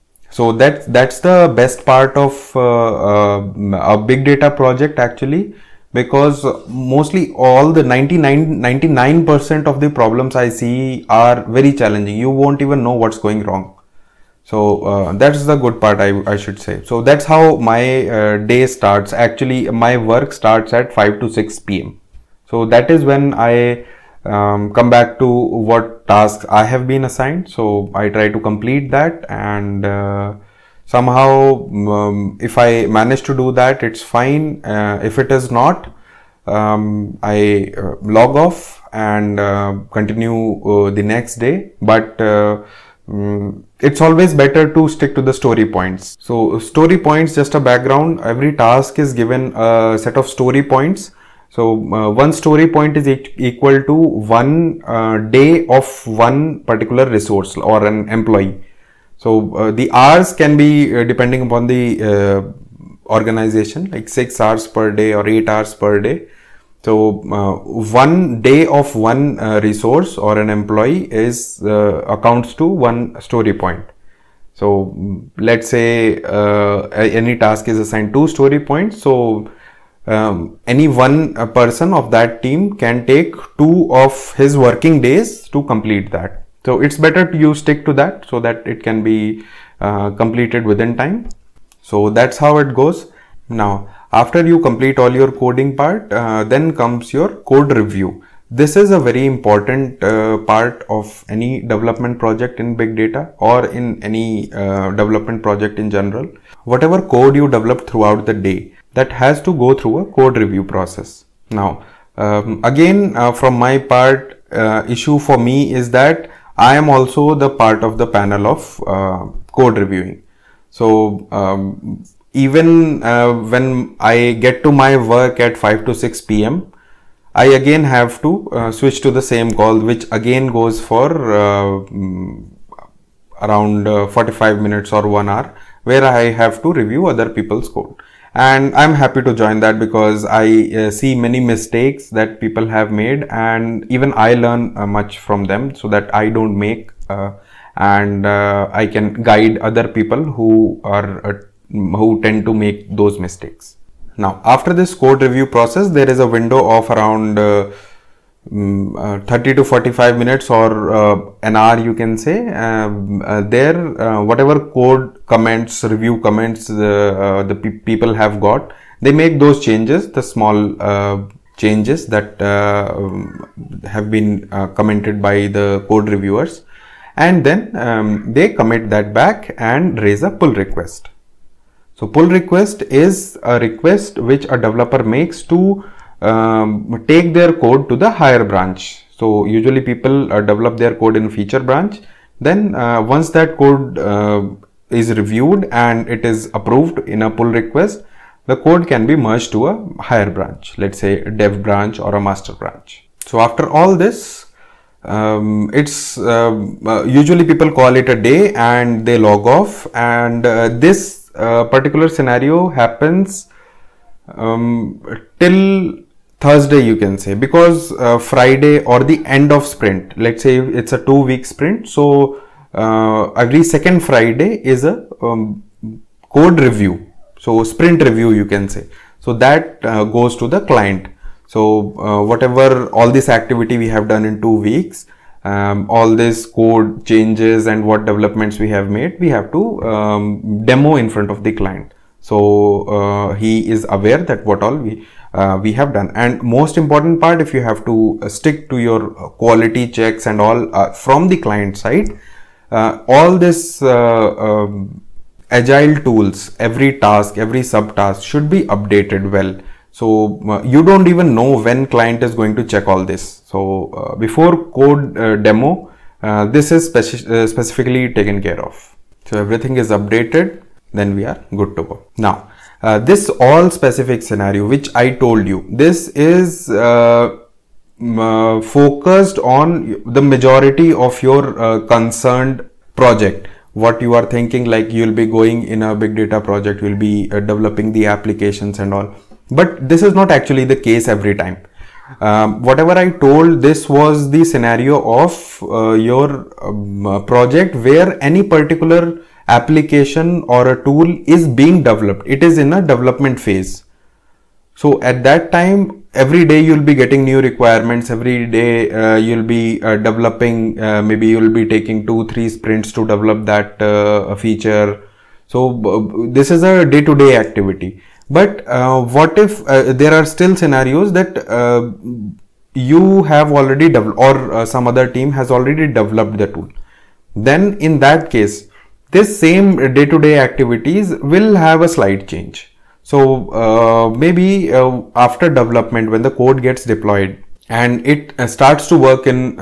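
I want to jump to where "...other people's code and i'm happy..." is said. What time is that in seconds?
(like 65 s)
137 s.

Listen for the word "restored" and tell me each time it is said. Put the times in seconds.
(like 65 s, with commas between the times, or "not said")
not said.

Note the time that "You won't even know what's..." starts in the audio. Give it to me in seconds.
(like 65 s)
12 s.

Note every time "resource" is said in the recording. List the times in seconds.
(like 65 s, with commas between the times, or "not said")
57 s, 69 s.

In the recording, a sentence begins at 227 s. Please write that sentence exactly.
So sprint review you can say.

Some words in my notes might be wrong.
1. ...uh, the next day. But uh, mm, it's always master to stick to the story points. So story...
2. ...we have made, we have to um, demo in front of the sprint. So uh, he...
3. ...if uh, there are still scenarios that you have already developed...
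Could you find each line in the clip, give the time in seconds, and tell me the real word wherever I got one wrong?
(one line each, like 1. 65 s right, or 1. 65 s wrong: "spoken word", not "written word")
1. 40 s wrong: "better", not "master"
2. 238 s wrong: "client", not "sprint"
3. 319 s right.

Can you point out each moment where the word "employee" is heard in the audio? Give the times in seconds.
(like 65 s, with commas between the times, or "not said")
58 s, 70 s.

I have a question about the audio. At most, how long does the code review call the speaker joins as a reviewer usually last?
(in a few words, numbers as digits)
one hour.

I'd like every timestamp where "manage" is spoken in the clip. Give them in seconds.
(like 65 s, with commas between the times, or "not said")
32 s.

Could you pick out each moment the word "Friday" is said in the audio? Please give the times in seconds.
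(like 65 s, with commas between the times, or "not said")
218 s, 224 s.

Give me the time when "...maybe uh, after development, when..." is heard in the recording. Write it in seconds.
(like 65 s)
334 s.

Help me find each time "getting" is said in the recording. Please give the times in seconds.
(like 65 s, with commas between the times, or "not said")
306 s.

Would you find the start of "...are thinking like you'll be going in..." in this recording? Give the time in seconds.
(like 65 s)
284 s.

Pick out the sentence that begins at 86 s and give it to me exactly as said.
So it's better you stick to that so that it can be uh, completed within time.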